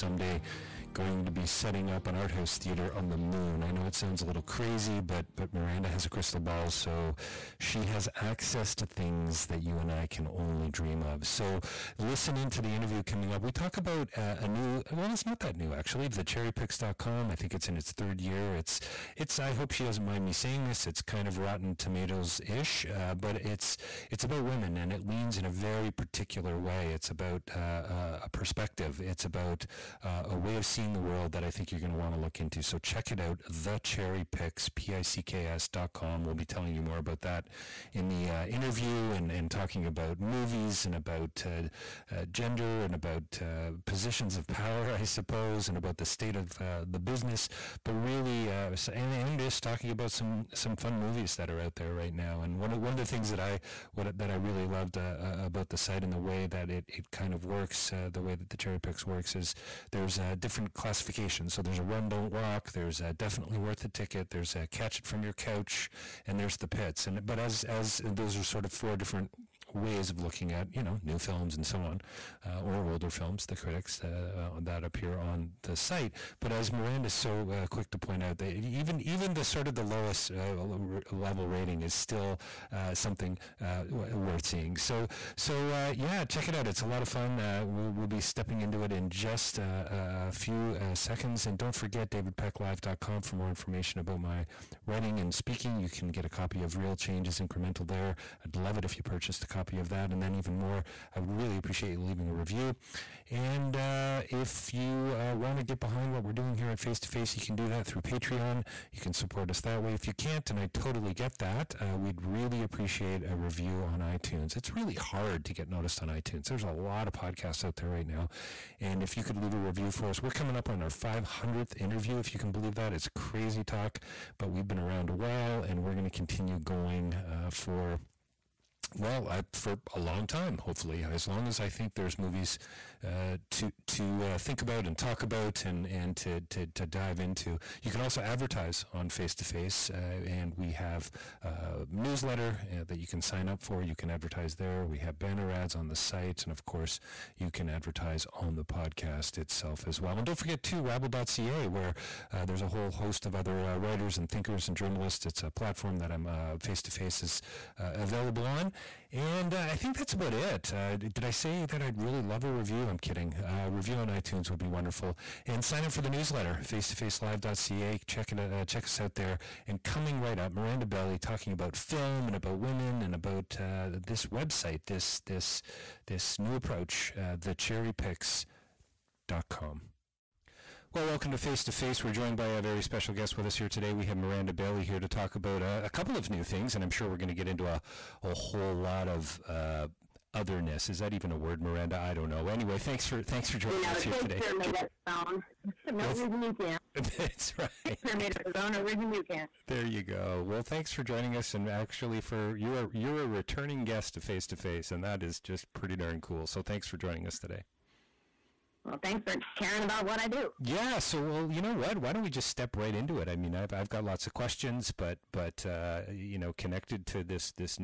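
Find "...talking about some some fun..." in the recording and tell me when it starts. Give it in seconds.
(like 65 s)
49 s.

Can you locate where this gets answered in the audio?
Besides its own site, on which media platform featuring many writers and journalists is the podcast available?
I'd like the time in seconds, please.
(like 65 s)
150 s.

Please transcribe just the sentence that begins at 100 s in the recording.
And then even more, I would really appreciate you leaving a review.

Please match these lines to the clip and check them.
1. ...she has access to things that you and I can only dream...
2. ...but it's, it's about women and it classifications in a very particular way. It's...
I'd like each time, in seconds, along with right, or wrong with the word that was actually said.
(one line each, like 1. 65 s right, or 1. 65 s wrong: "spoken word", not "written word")
1. 7 s right
2. 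23 s wrong: "leans", not "classifications".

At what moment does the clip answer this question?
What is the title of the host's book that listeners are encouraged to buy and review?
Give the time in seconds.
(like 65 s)
96 s.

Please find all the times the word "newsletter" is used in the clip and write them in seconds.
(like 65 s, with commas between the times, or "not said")
141 s, 166 s.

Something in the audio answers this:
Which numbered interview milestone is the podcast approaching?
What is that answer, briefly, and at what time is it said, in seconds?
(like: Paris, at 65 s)
500th, at 120 s.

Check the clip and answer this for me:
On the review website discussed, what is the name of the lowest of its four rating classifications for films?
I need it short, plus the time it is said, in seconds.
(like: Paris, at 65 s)
The Pits, at 66 s.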